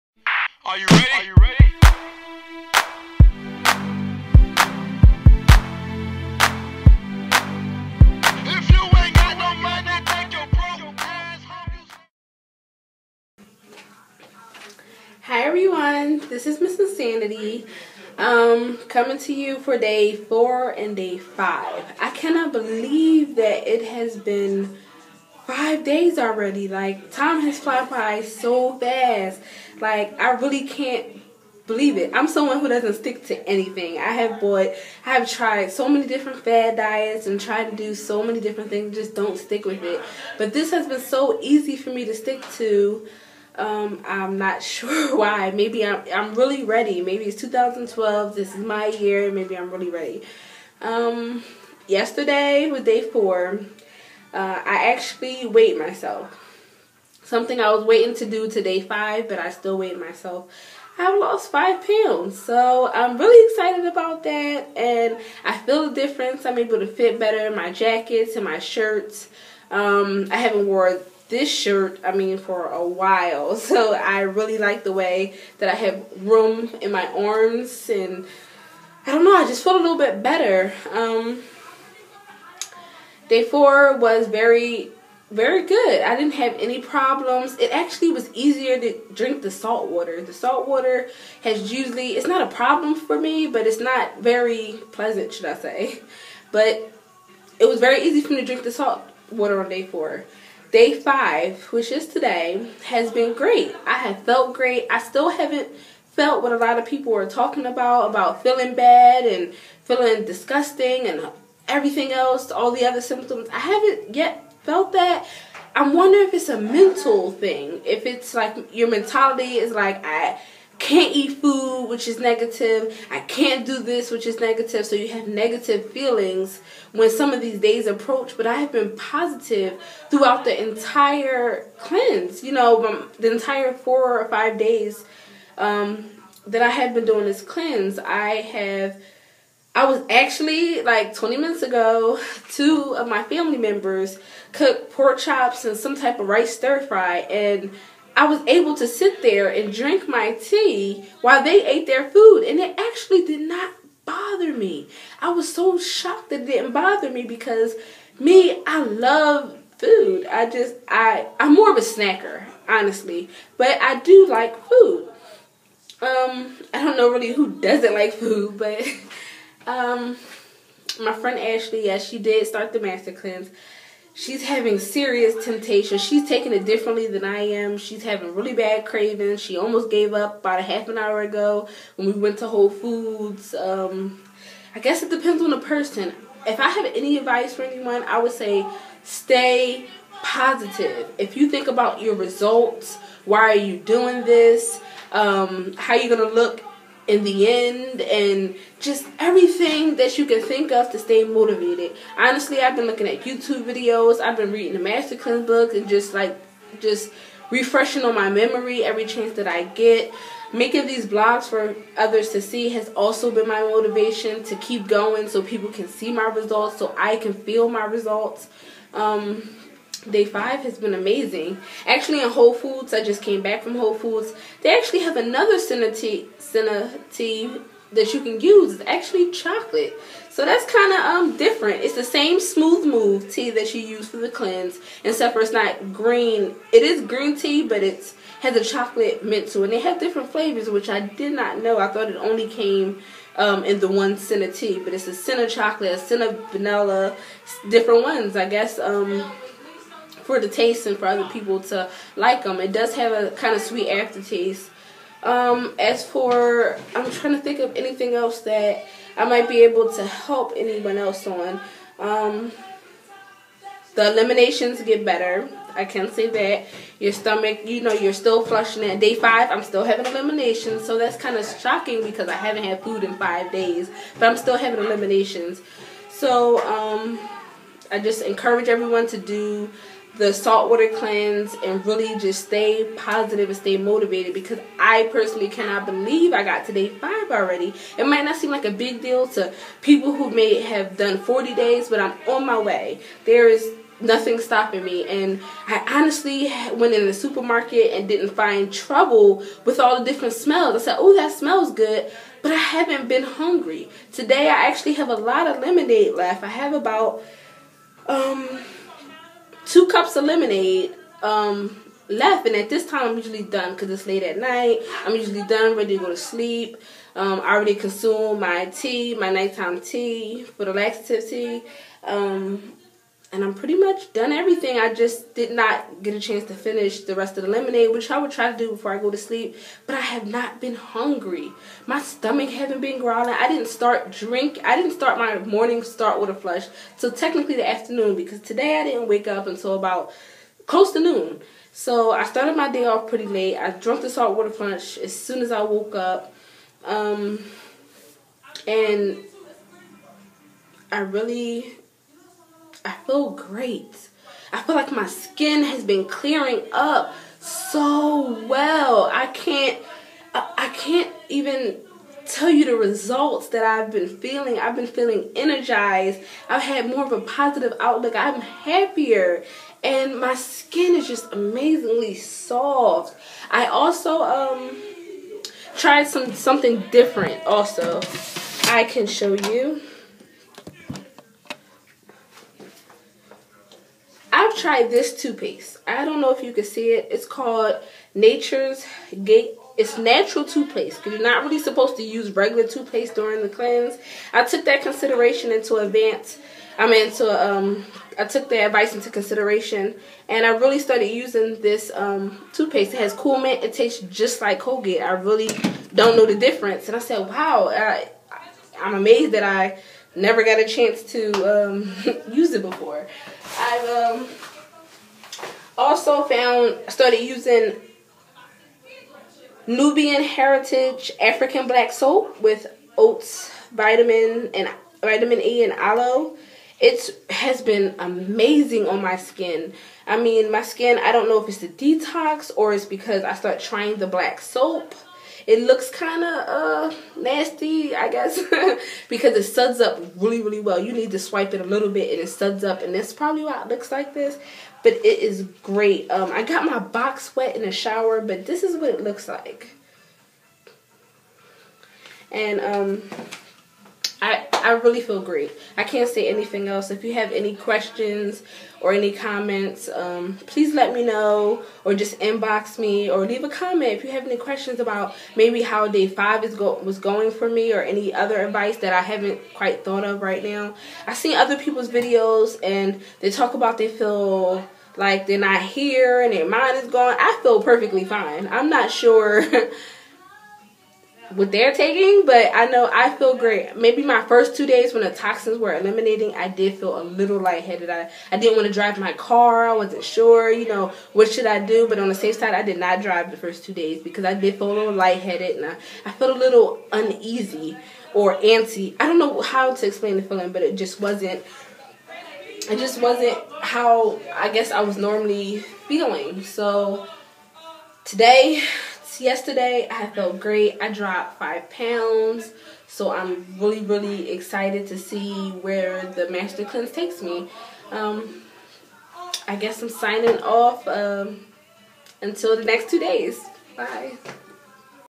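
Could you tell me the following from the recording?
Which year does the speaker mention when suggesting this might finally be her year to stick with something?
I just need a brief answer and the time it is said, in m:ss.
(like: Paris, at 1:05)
2012, at 0:47.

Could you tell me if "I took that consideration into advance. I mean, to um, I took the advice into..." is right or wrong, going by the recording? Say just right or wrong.
right.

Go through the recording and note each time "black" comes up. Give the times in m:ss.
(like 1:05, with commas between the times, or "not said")
7:01, 7:14.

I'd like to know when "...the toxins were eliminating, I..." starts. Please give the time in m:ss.
8:05.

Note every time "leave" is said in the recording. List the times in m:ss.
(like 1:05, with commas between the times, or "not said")
7:43.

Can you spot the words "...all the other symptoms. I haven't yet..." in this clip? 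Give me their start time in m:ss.
1:52.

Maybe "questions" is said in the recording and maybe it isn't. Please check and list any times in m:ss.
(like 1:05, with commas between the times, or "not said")
7:37, 7:44.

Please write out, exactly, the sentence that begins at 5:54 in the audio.
I feel like my skin has been clearing up so well.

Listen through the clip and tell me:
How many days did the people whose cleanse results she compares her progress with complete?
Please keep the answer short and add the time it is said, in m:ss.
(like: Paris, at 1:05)
40, at 4:51.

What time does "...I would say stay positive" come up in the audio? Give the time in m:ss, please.
3:08.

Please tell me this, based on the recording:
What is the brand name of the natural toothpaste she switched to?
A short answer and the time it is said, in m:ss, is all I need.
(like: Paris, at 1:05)
Nature's Gate, at 6:28.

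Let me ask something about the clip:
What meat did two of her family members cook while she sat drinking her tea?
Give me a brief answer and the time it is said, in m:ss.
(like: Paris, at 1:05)
Pork chops, at 2:24.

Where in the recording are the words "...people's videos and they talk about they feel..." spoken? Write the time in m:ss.
7:51.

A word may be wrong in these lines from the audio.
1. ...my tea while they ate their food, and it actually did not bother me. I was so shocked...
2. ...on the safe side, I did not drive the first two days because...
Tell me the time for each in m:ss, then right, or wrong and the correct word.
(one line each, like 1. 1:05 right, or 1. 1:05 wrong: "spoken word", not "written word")
1. 2:30 right
2. 8:11 right.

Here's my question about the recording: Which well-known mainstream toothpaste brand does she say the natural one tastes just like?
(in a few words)
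Colgate.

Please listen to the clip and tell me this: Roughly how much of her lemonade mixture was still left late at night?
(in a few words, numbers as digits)
2 cups.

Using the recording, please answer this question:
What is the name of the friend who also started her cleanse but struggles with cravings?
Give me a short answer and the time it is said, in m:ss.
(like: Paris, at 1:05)
Ashley, at 2:51.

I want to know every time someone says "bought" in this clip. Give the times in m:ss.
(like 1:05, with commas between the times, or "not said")
0:34.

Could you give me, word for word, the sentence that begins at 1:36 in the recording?
But it was very easy for me to drink the salt water on day four.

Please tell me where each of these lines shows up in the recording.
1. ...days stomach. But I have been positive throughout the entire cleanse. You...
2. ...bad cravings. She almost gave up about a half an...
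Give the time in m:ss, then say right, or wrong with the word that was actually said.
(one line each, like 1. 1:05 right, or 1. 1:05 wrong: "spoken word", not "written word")
1. 2:07 wrong: "approach", not "stomach"
2. 2:58 right.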